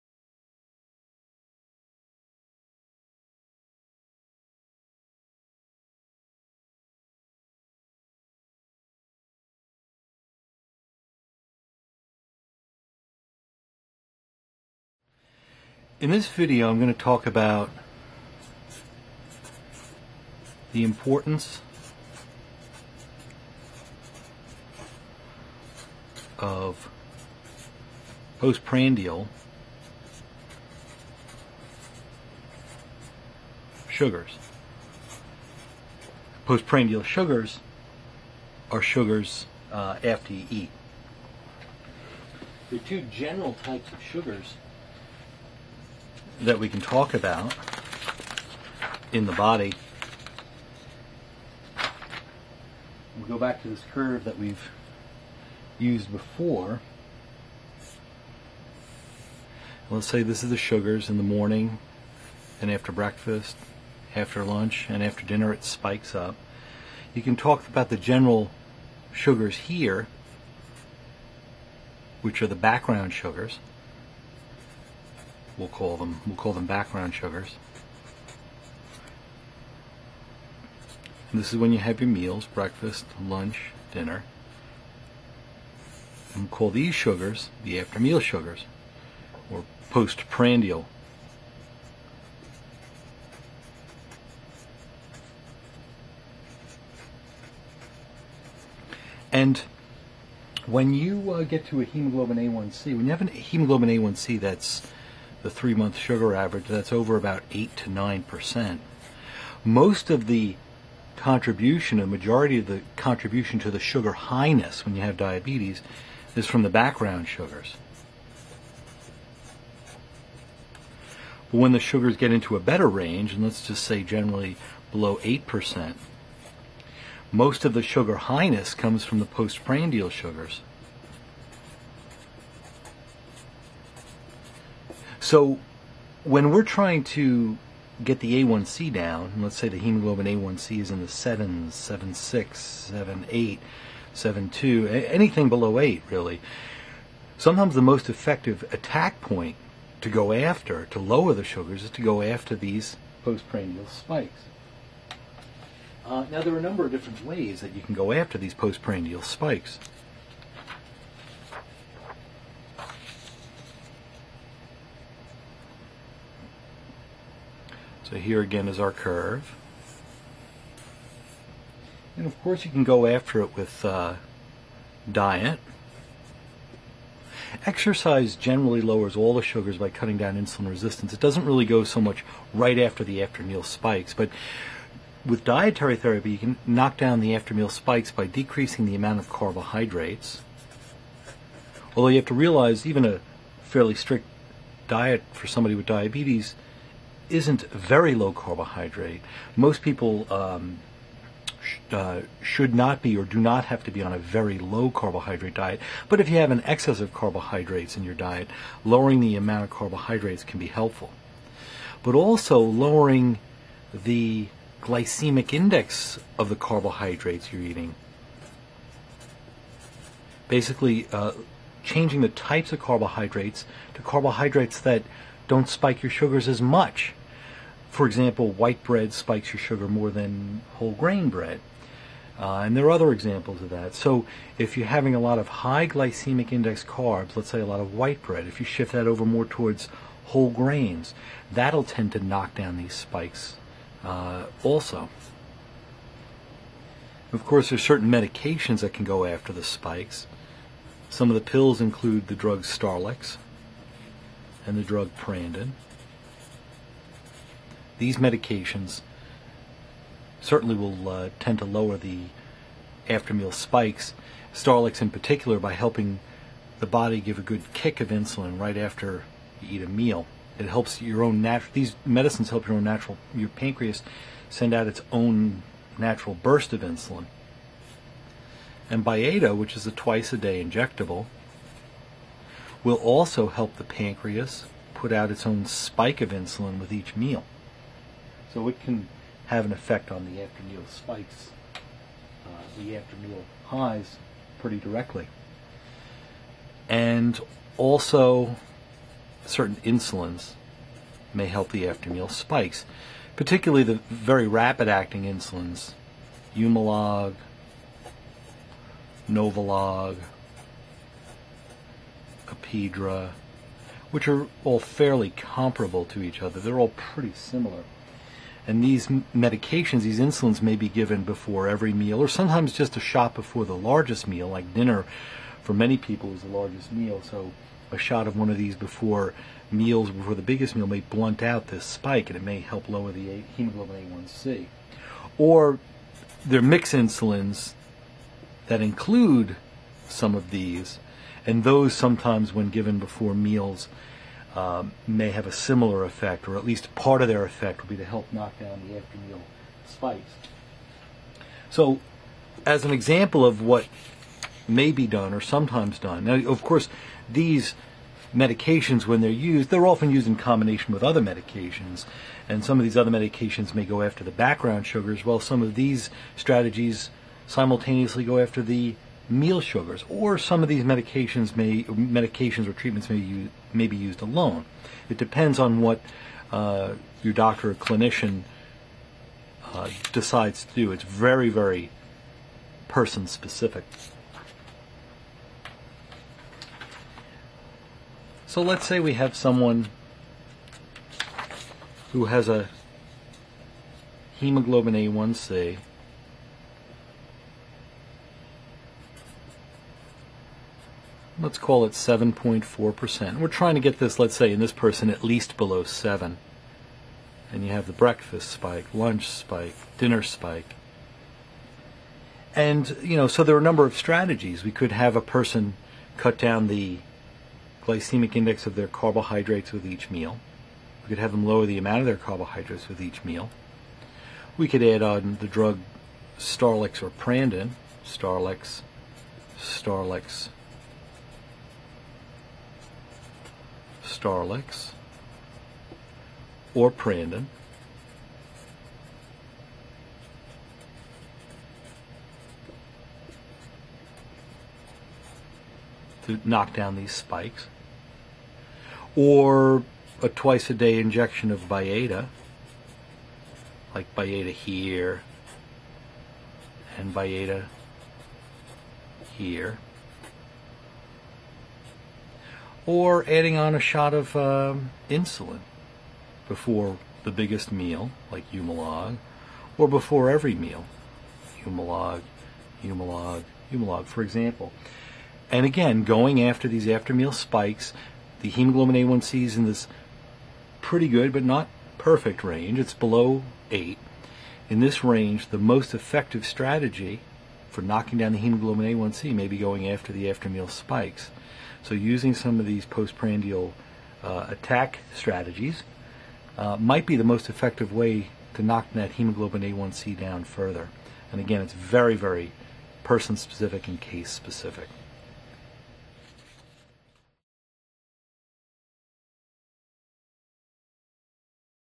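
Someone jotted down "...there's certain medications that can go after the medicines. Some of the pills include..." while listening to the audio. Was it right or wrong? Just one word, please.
wrong.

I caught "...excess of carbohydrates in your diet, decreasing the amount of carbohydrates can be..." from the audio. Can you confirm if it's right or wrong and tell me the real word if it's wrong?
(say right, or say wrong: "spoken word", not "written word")
wrong: "lowering", not "decreasing".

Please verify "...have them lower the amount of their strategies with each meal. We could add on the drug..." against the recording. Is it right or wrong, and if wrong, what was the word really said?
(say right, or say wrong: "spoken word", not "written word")
wrong: "carbohydrates", not "strategies".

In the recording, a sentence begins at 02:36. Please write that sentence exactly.
Uh, now, there are a number of different ways that you can go after these postprandial spikes.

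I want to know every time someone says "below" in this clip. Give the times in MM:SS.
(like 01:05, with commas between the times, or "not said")
02:04, 02:25, 06:45, 08:02.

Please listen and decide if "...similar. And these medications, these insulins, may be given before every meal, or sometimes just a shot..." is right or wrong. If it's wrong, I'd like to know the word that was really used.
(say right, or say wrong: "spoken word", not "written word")
right.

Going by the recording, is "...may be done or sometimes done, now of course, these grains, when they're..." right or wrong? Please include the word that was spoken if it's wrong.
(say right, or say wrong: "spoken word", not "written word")
wrong: "medications", not "grains".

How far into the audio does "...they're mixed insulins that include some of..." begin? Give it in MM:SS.
05:36.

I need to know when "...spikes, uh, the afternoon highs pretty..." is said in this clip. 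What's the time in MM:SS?
04:50.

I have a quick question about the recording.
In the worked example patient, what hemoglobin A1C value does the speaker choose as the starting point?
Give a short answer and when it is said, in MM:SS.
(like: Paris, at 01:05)
7.4%, at 06:41.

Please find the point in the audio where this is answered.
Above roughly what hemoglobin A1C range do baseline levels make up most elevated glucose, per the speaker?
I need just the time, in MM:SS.
01:47.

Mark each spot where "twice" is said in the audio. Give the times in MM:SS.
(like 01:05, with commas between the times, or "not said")
04:39, 07:30.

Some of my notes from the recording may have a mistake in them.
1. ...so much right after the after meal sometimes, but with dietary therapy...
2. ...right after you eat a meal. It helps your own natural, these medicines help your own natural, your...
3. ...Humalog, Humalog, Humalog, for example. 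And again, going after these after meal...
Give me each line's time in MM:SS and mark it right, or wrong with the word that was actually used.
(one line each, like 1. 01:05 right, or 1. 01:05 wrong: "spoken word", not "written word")
1. 03:01 wrong: "spikes", not "sometimes"
2. 04:28 right
3. 07:51 right.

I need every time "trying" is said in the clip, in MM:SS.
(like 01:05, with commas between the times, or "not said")
02:16, 06:43.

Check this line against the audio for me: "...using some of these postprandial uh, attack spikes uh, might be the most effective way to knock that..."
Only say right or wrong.
wrong.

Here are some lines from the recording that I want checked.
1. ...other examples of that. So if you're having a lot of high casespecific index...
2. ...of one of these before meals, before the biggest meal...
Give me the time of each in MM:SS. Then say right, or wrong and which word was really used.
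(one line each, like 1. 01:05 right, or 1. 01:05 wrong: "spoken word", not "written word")
1. 03:52 wrong: "glycemic", not "casespecific"
2. 05:28 right.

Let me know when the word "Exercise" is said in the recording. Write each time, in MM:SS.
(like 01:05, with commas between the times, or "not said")
02:57.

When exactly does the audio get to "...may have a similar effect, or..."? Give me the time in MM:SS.
05:45.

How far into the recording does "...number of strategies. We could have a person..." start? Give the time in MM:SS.
06:53.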